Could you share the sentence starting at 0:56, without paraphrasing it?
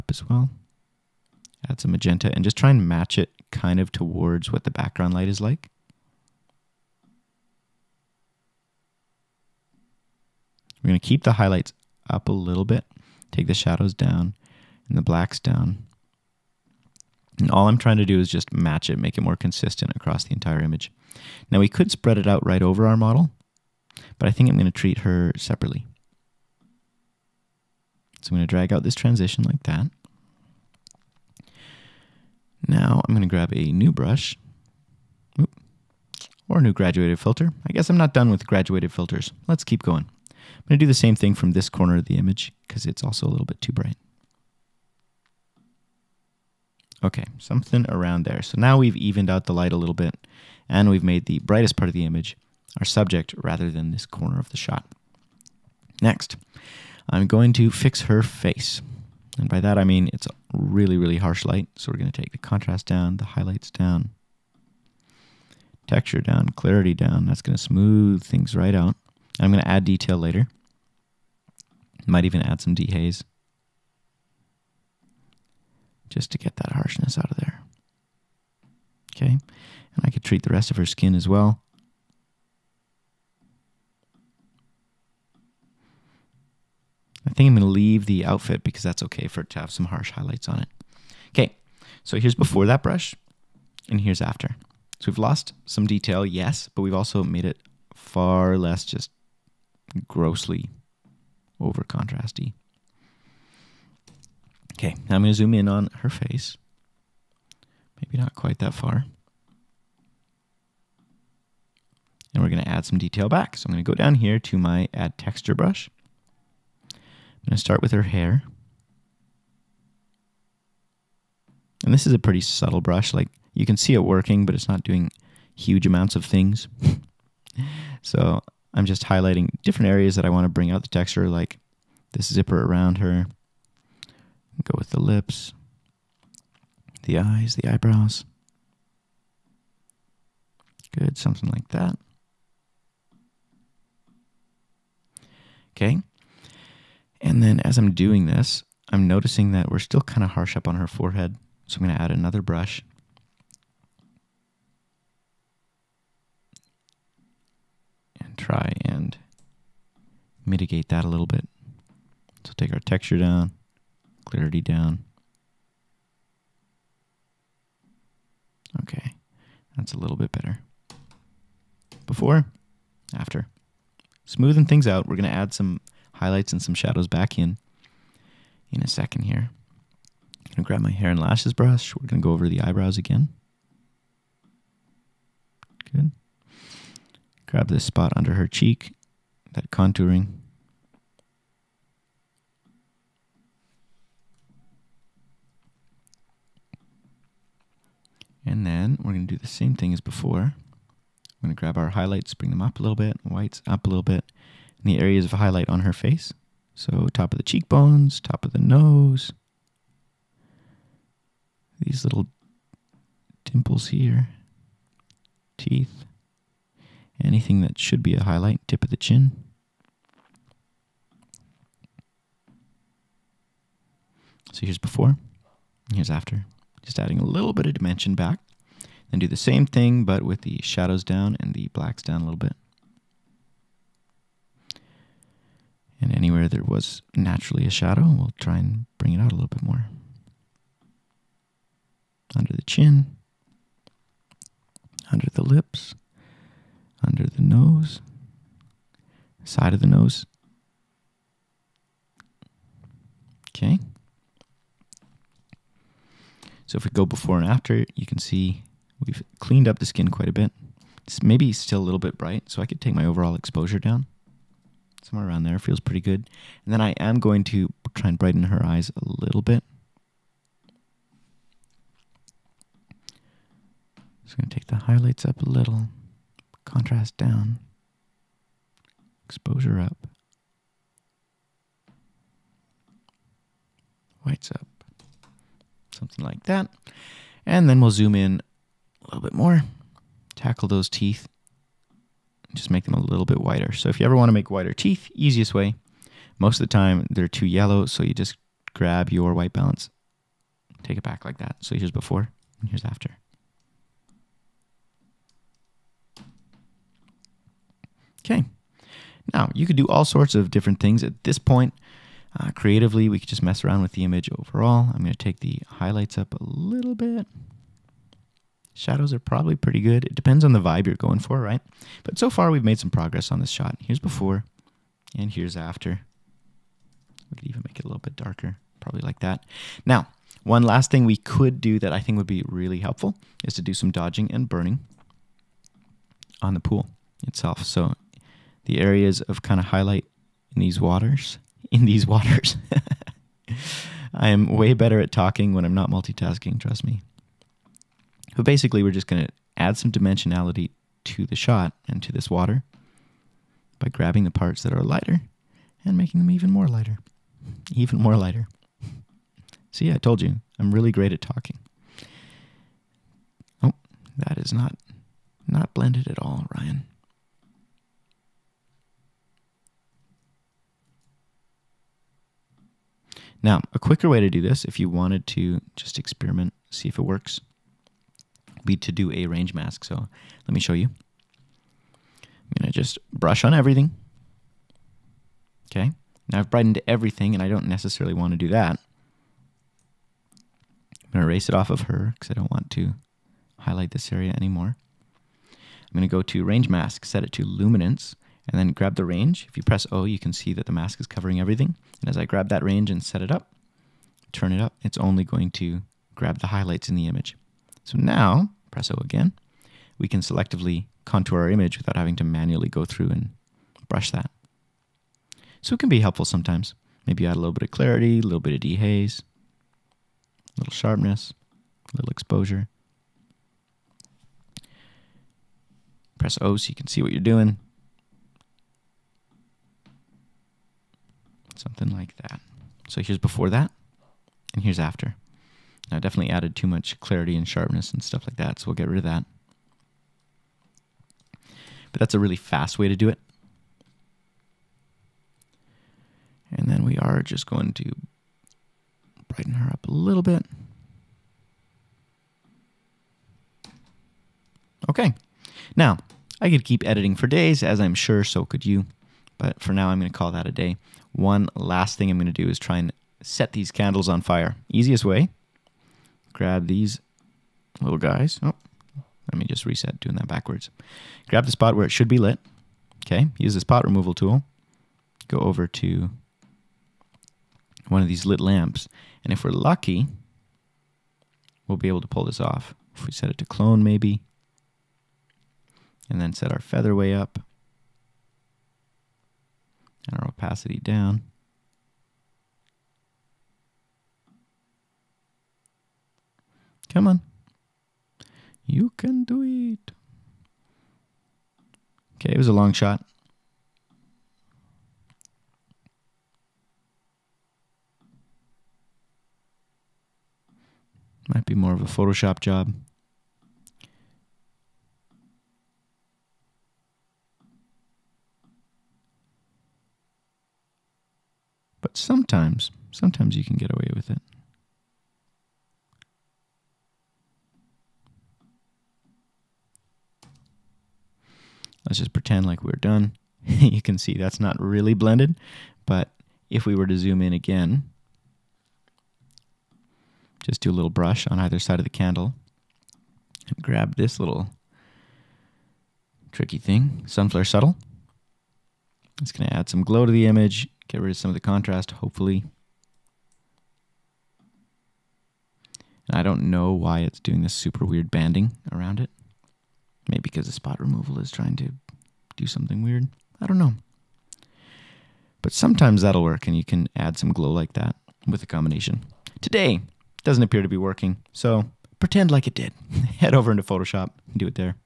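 Next, I'm going to fix her face.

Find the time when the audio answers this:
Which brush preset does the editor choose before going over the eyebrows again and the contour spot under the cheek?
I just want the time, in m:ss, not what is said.
3:00.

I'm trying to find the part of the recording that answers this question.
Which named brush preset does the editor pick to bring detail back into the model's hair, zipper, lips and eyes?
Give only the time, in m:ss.
1:54.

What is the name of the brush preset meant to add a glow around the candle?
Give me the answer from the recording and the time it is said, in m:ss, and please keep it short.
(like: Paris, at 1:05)
Sunflare Subtle, at 9:07.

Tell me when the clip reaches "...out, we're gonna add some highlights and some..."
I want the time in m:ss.
2:54.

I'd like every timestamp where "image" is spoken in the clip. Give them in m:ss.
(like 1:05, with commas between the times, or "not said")
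0:20, 0:42, 0:52, 5:14, 6:47, 6:51, 9:10.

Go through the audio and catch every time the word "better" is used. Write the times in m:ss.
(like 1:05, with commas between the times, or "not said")
2:50, 5:44.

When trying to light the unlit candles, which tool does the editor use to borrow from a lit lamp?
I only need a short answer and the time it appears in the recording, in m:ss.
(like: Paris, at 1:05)
Spot removal tool, at 7:53.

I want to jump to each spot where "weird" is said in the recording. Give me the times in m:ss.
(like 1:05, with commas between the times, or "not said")
9:17, 9:22.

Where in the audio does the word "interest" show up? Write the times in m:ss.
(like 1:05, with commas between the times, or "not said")
not said.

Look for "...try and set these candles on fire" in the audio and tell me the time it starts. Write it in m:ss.
7:42.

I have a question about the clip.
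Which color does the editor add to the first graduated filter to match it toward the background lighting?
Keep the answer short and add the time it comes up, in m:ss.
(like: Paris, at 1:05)
Magenta, at 0:01.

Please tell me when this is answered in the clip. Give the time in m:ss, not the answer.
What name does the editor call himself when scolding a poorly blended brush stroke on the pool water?
6:06.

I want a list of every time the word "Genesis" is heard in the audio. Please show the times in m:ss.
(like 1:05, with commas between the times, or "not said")
not said.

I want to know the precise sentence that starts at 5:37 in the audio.
So the areas of kind of highlight in these waters.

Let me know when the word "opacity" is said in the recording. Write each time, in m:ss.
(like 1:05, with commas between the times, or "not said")
8:10.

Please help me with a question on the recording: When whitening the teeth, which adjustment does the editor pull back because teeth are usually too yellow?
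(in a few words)
White balance.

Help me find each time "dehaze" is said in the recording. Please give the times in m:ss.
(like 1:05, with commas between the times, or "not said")
1:12, 6:58.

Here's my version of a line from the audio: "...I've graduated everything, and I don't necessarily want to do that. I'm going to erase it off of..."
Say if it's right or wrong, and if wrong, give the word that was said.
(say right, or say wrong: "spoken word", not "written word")
wrong: "brightened", not "graduated".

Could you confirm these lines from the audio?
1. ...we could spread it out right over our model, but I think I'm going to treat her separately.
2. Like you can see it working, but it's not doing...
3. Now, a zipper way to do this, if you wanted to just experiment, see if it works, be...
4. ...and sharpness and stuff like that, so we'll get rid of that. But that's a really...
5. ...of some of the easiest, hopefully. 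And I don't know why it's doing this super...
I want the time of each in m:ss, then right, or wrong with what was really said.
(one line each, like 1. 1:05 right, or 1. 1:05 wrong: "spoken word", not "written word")
1. 0:21 right
2. 2:03 right
3. 6:13 wrong: "quicker", not "zipper"
4. 7:17 right
5. 9:11 wrong: "contrast", not "easiest".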